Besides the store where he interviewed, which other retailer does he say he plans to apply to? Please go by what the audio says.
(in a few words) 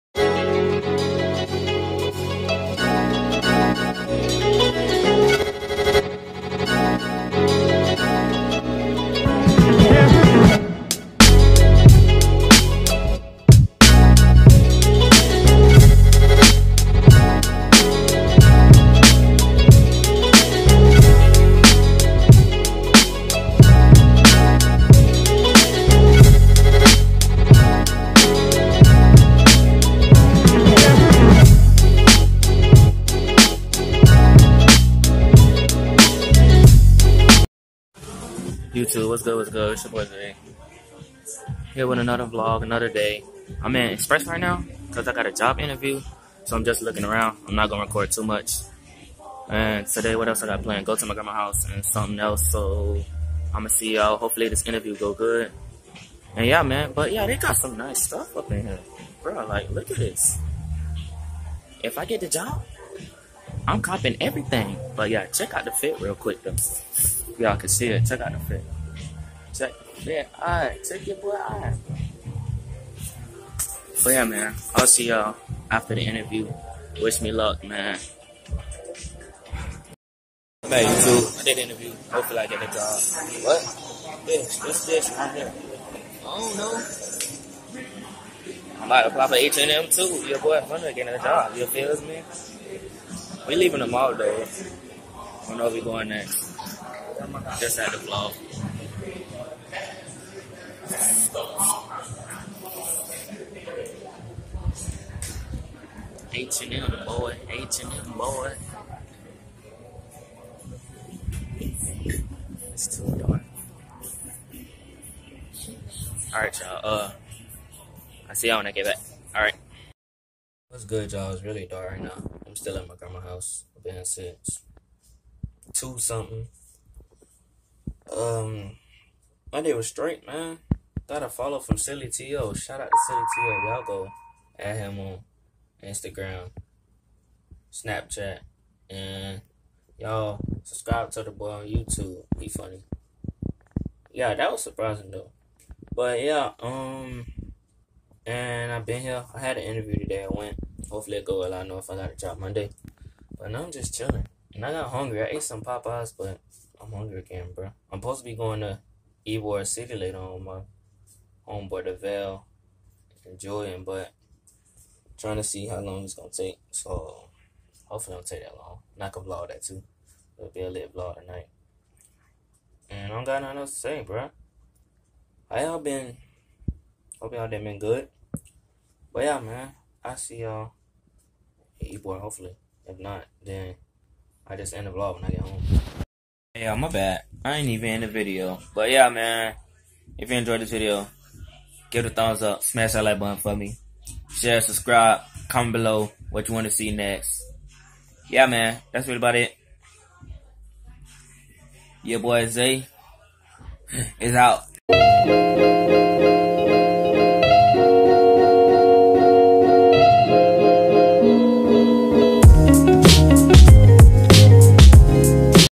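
H&M.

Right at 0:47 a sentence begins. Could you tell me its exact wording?
I'm not going to record too much.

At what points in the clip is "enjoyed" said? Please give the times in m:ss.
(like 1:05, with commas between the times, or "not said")
3:10.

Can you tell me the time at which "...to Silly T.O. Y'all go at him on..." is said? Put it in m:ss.
2:12.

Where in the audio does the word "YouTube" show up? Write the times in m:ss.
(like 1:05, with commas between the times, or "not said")
0:38, 1:20, 2:21.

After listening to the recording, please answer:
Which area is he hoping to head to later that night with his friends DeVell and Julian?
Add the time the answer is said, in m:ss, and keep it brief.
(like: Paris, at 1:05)
Ybor City, at 2:39.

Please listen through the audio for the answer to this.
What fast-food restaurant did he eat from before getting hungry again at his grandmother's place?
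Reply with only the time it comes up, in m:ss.
2:35.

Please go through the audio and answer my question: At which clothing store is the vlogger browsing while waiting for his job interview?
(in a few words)
Express.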